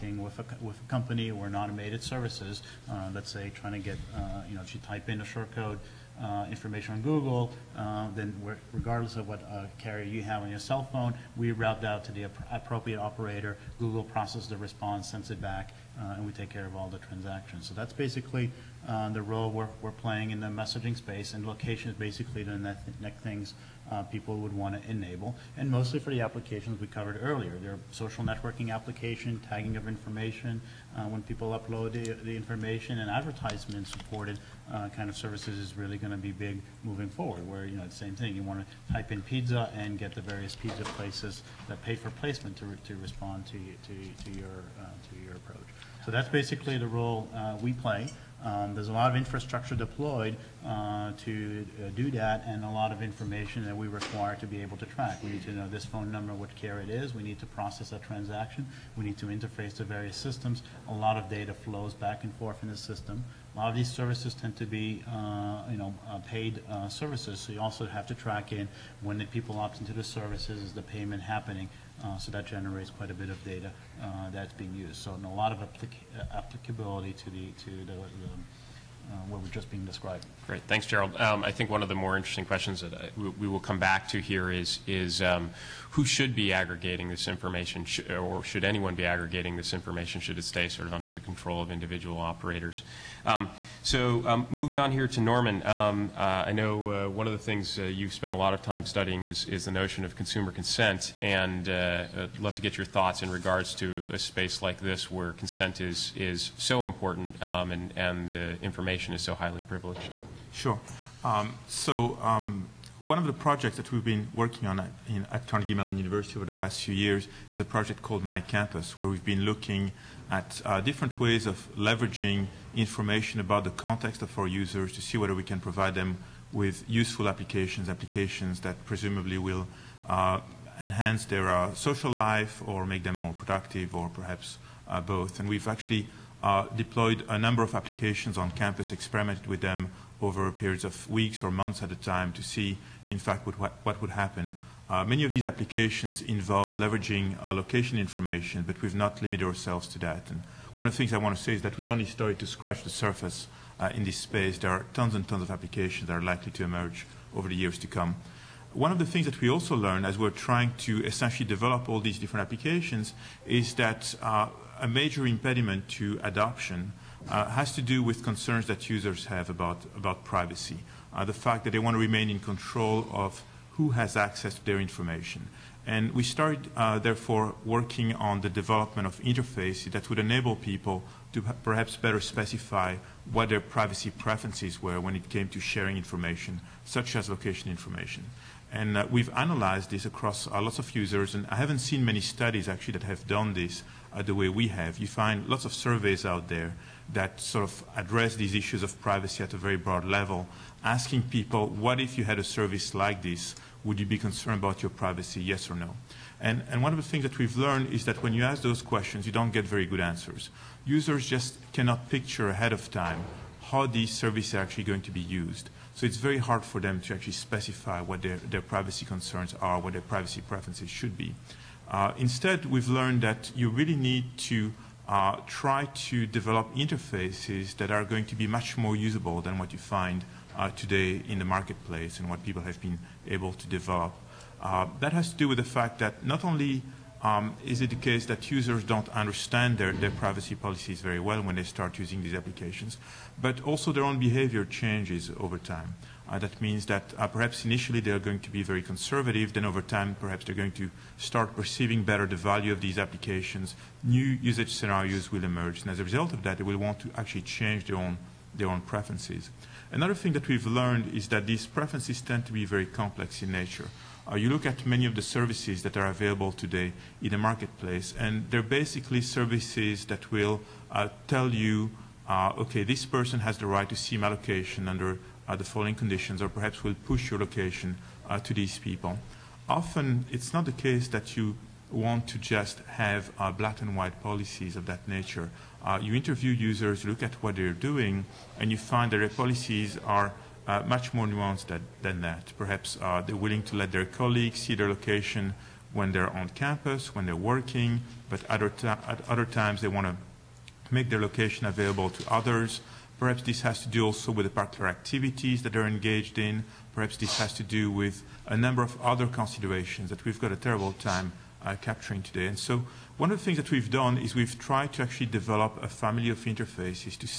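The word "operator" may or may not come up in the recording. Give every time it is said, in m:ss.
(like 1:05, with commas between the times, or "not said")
0:12, 1:32.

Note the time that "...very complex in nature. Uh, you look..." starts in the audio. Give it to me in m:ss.
4:22.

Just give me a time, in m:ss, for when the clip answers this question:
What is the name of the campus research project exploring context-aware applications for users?
1:58.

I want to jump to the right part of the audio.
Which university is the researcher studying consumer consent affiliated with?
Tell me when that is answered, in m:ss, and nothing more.
1:55.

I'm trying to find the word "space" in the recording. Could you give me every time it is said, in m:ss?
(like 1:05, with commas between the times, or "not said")
0:20, 1:44, 2:34.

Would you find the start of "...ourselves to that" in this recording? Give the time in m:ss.
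2:29.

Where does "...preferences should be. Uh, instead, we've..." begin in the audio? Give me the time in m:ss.
3:40.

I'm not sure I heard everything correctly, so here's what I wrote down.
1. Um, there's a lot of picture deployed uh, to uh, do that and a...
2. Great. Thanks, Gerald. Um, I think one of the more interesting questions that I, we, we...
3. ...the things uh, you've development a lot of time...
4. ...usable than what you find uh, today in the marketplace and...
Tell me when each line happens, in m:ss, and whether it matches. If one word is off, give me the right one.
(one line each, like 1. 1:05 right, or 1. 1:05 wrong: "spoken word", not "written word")
1. 0:48 wrong: "infrastructure", not "picture"
2. 1:20 right
3. 1:37 wrong: "spent", not "development"
4. 3:48 right.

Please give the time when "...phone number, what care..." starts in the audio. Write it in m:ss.
0:55.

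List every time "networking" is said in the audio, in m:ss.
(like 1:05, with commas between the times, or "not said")
0:28.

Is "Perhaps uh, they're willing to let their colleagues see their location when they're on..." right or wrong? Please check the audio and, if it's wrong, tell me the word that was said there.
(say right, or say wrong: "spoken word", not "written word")
right.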